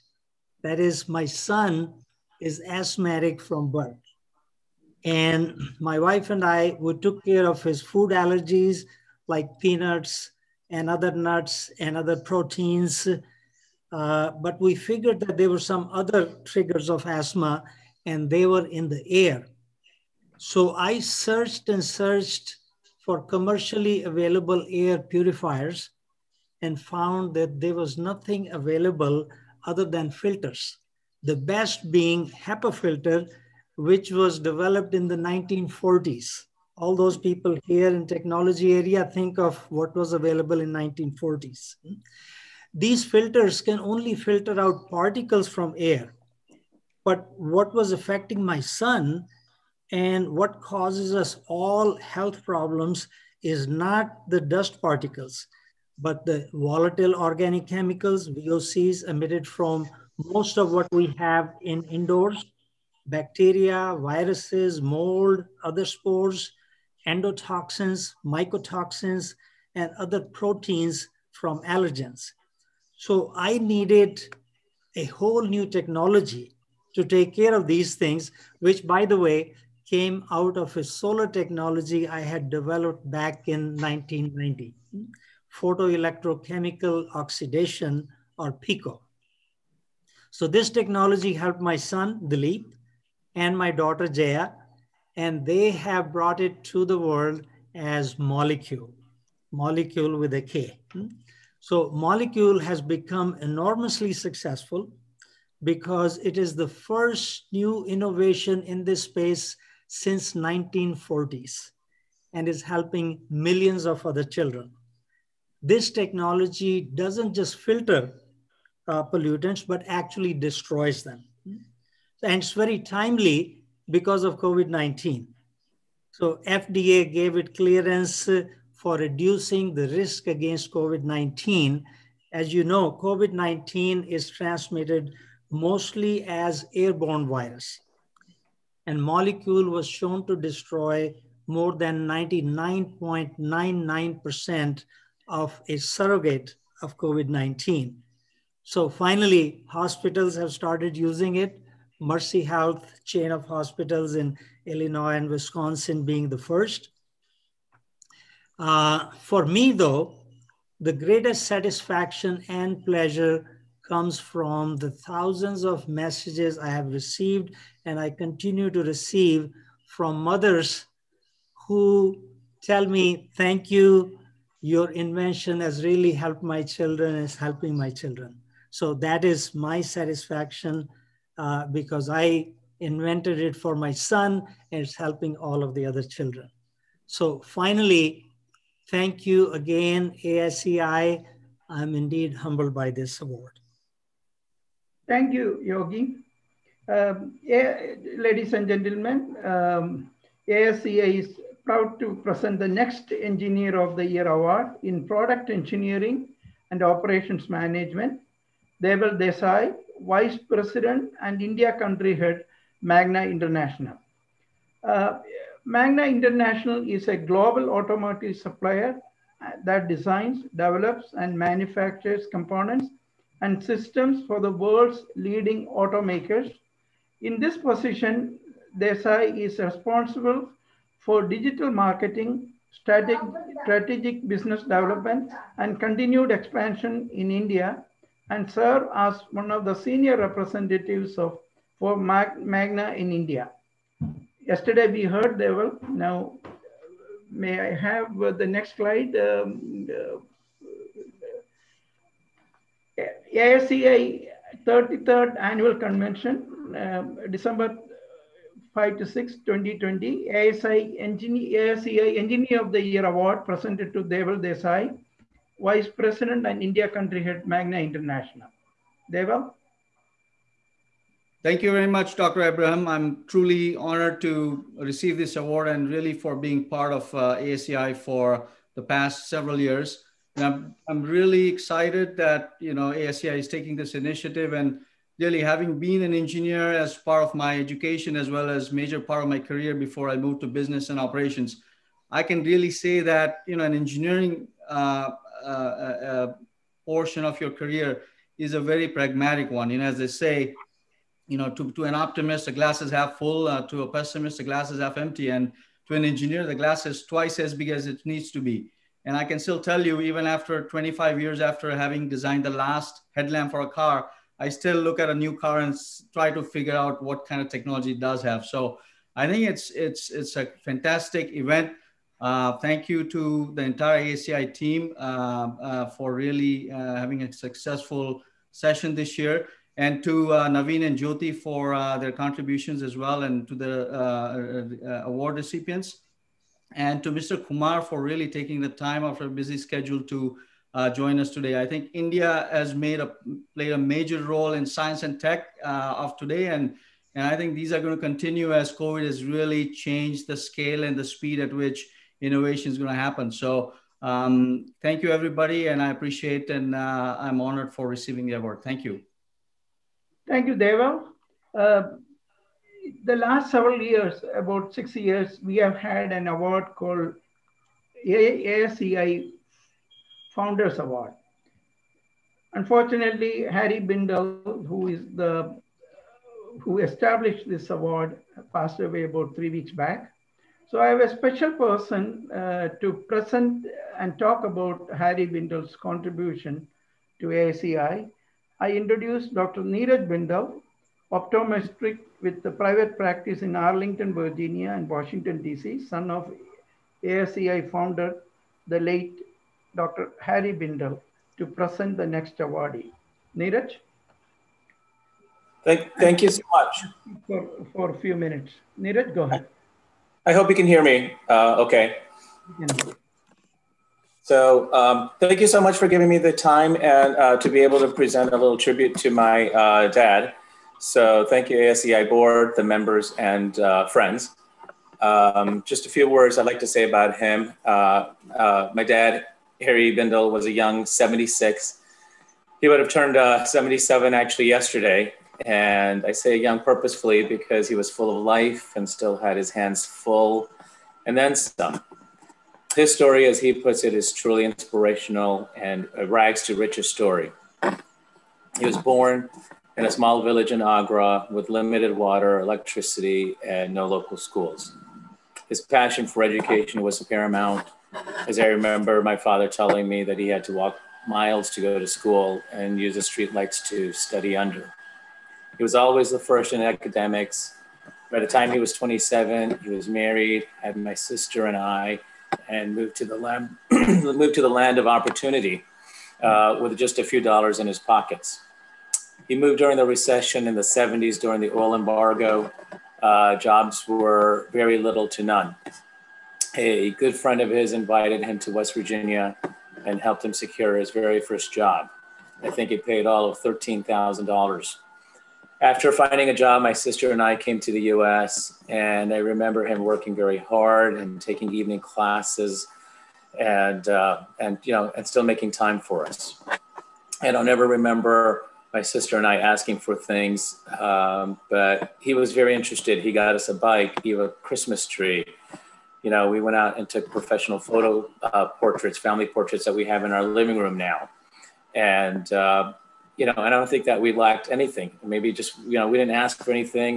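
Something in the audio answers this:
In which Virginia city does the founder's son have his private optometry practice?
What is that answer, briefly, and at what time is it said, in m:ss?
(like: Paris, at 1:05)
Arlington, at 6:33.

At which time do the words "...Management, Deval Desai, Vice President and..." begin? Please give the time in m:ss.
3:27.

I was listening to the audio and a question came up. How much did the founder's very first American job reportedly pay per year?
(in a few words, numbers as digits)
$13,000.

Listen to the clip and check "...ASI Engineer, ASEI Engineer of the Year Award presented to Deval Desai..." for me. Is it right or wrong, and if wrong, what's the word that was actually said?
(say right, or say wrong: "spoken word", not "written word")
right.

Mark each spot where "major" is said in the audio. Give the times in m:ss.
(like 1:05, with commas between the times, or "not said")
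4:48, 5:43.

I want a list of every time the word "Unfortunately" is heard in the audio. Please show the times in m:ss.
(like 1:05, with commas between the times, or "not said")
6:12.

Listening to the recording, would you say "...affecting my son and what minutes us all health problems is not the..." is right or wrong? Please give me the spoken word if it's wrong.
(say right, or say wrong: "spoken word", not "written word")
wrong: "causes", not "minutes".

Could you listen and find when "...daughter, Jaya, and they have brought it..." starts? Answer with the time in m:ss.
1:33.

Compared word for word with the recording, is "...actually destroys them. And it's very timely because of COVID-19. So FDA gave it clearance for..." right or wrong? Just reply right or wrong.
right.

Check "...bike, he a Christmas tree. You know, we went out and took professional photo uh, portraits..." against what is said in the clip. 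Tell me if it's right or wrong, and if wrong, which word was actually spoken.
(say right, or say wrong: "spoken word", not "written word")
right.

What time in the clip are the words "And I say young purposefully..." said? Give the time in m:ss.
7:15.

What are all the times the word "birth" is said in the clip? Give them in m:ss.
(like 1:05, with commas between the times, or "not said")
0:03.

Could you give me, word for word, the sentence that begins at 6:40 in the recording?
Harry Bindal, to present the next awardee.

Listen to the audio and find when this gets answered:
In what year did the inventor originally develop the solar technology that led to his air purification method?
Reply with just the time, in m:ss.
1:23.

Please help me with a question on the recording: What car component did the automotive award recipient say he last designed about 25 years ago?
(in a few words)
headlamp.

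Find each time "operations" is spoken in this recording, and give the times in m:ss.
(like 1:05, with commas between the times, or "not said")
3:26, 4:50.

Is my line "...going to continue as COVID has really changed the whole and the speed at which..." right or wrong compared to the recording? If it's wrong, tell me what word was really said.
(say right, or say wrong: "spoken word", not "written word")
wrong: "scale", not "whole".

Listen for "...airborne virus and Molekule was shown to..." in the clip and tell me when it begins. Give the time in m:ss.
2:16.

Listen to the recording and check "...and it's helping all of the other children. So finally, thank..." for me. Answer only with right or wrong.
right.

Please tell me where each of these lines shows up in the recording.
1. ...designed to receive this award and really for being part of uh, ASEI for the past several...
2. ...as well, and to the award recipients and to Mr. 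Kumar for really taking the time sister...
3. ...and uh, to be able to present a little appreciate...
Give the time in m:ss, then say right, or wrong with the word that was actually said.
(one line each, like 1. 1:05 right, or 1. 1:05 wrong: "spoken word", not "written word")
1. 4:33 wrong: "honored", not "designed"
2. 5:32 wrong: "after", not "sister"
3. 6:56 wrong: "tribute", not "appreciate".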